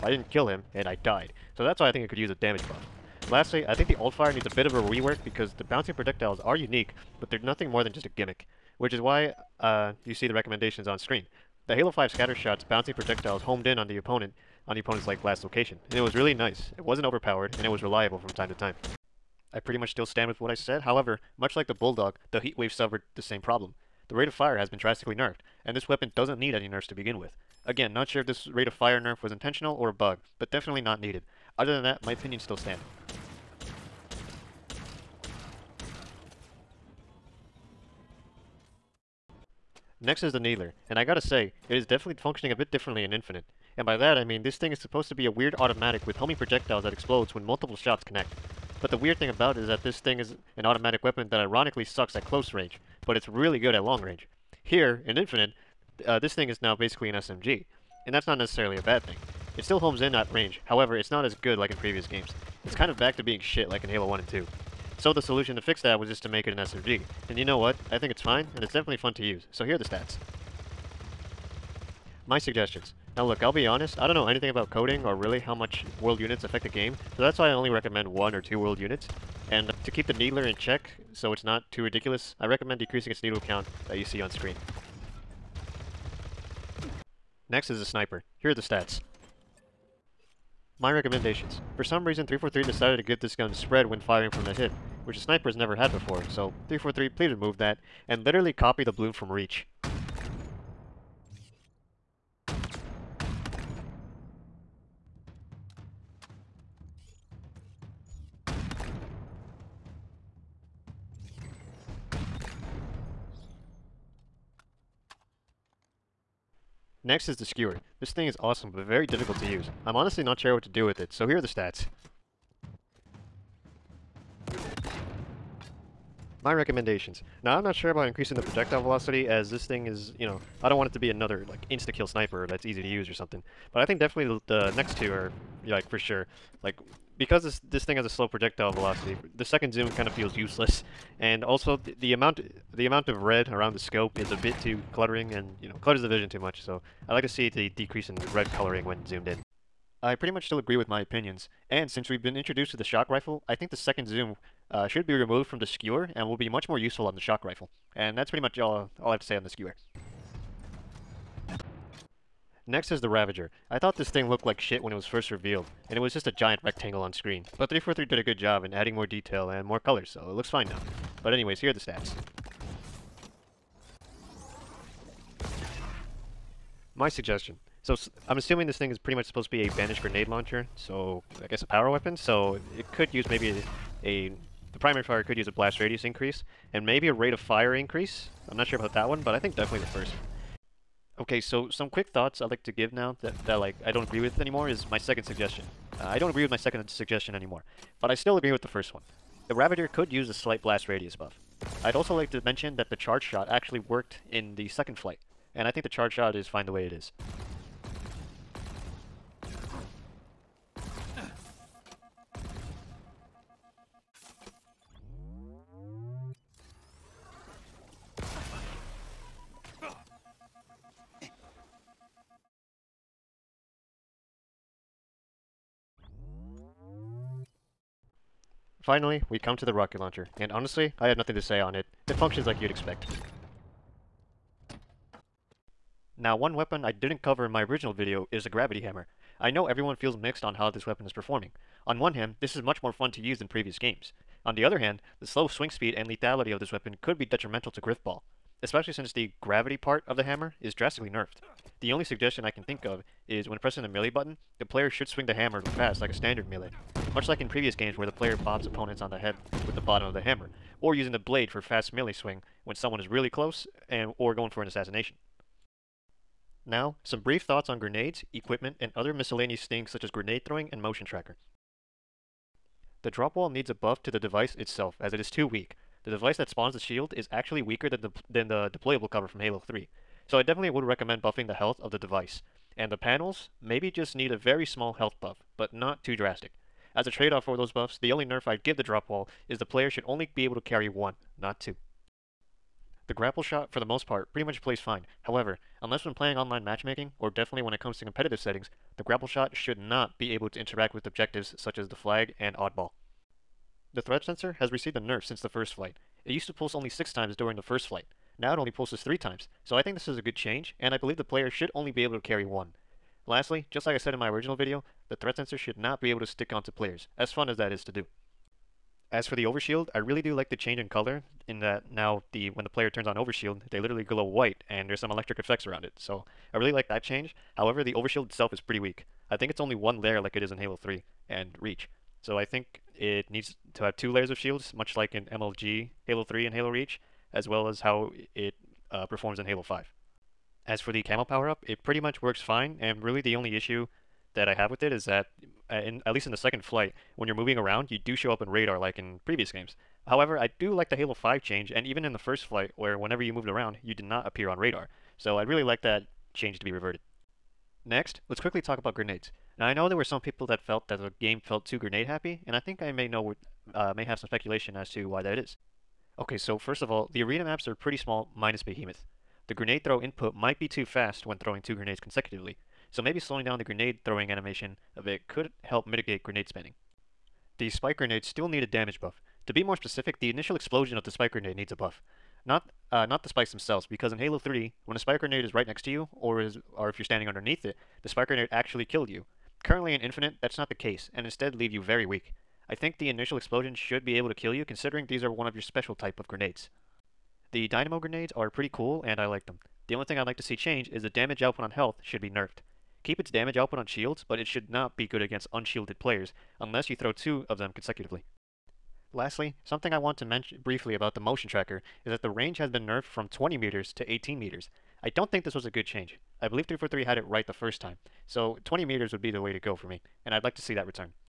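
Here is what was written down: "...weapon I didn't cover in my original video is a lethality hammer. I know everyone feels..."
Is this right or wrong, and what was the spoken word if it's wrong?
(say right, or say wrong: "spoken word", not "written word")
wrong: "gravity", not "lethality".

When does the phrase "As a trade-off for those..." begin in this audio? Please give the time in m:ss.
4:46.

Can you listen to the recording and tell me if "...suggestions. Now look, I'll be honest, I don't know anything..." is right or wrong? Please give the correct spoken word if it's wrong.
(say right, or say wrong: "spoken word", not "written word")
right.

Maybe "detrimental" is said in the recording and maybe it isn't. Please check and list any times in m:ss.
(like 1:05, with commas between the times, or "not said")
4:07.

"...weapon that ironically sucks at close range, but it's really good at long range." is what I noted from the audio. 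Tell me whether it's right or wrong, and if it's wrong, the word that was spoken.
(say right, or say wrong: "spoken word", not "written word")
right.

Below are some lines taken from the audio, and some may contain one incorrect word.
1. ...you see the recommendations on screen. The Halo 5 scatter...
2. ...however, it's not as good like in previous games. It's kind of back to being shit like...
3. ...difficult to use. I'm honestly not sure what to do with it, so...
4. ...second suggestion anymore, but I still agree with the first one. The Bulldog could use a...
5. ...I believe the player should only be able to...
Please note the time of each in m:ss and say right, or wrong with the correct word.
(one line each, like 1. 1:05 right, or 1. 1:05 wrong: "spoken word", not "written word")
1. 0:10 right
2. 1:00 right
3. 1:59 right
4. 3:16 wrong: "Ravager", not "Bulldog"
5. 5:10 right.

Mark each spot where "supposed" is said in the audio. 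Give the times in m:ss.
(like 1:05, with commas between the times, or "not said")
0:44, 2:59.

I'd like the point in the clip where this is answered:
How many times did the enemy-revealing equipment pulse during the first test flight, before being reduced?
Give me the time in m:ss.
5:06.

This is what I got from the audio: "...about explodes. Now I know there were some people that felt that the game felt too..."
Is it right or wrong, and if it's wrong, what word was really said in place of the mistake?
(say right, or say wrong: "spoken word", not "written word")
wrong: "grenades", not "explodes".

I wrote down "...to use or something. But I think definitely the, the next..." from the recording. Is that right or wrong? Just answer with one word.
right.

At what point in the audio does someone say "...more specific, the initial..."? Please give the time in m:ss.
6:19.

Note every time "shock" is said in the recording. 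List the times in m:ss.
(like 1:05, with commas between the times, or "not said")
2:32, 2:37.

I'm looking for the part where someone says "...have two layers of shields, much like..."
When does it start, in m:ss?
5:33.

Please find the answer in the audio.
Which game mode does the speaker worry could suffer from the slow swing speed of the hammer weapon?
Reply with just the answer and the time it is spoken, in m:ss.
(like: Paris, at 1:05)
Grifball, at 4:07.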